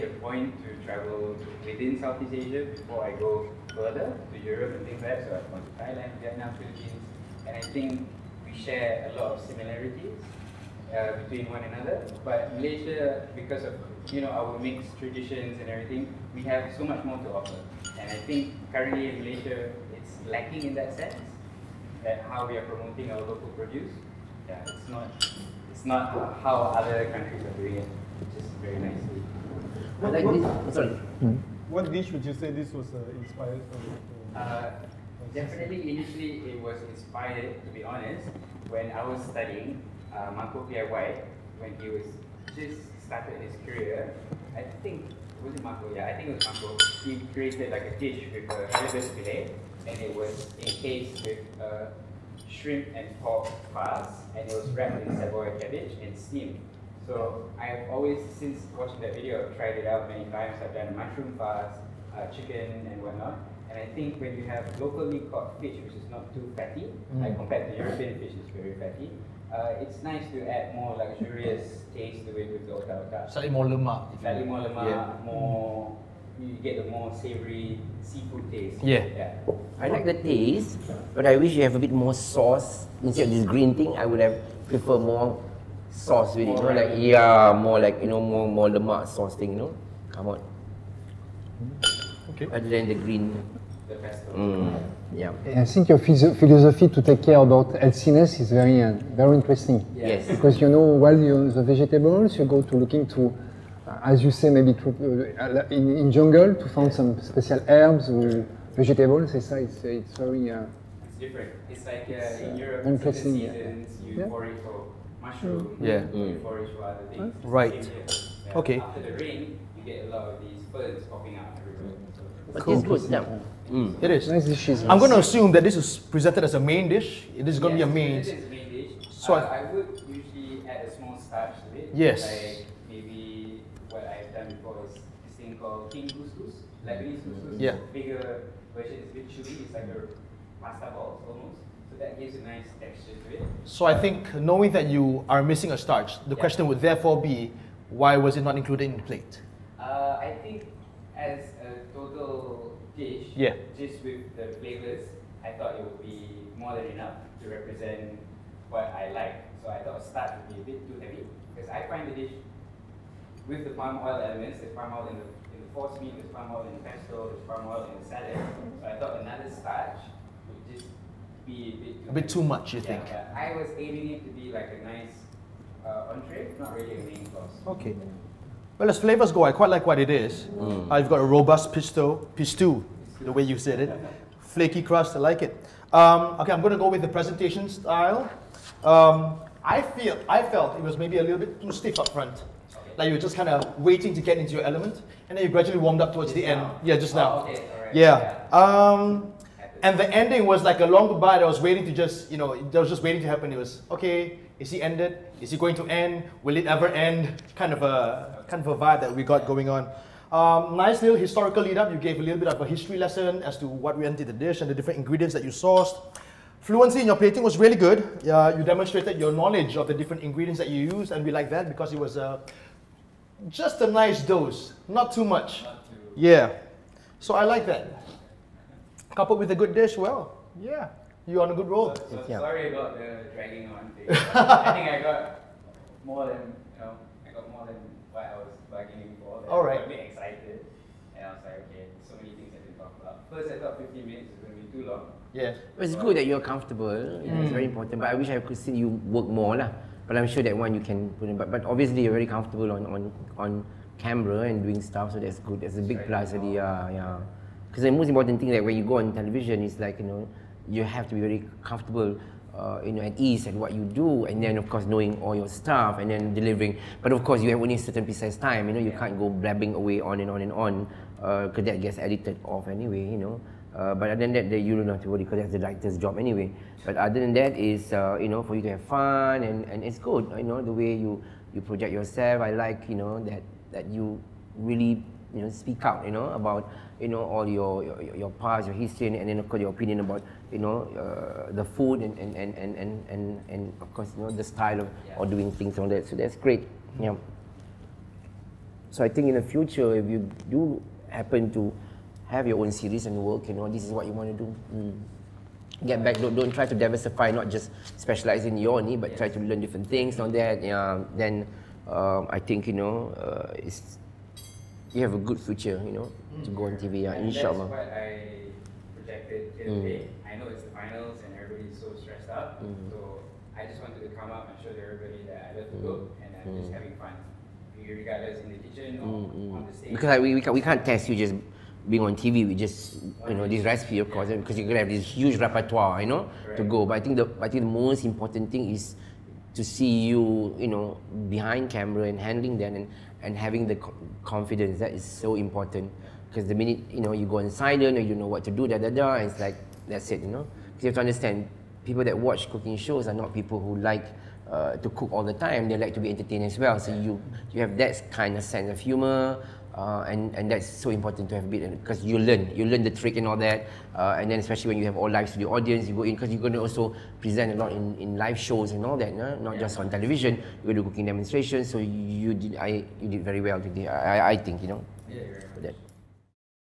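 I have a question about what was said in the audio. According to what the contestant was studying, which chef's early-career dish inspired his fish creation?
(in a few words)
Marco White.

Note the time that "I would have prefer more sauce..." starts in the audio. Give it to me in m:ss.
1:23.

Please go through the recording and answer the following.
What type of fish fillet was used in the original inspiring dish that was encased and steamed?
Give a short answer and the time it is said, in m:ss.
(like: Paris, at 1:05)
Halibut, at 0:48.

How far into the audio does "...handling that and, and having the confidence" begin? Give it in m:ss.
5:42.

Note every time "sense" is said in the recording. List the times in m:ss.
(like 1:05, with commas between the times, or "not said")
0:20, 5:58.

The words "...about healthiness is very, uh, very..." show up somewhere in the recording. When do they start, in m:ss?
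1:37.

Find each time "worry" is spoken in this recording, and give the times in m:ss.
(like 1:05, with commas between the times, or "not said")
1:54, 4:35.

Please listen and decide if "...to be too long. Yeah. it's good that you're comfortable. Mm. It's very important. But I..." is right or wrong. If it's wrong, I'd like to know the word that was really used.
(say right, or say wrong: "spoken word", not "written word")
right.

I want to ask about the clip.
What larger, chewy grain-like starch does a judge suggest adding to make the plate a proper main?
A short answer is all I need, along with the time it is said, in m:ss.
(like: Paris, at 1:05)
King couscous, at 2:15.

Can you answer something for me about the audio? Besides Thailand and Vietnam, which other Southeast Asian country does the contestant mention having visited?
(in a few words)
Philippines.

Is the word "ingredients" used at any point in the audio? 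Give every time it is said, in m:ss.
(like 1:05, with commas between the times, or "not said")
3:34, 3:40.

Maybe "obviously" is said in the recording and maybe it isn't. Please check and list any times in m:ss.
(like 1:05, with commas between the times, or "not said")
4:11.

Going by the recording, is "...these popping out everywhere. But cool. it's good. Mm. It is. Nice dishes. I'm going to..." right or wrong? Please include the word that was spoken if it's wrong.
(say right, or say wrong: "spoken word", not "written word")
right.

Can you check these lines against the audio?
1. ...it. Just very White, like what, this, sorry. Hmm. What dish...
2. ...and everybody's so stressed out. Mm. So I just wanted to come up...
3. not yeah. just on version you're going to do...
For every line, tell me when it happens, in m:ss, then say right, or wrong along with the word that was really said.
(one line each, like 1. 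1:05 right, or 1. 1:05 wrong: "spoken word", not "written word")
1. 0:27 wrong: "What", not "White"
2. 5:21 right
3. 6:09 wrong: "television", not "version".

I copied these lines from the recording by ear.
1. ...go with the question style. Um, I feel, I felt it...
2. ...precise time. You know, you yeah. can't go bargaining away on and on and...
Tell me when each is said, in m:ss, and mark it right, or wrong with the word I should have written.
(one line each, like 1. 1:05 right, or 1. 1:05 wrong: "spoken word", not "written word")
1. 3:06 wrong: "presentation", not "question"
2. 4:28 wrong: "blabbing", not "bargaining".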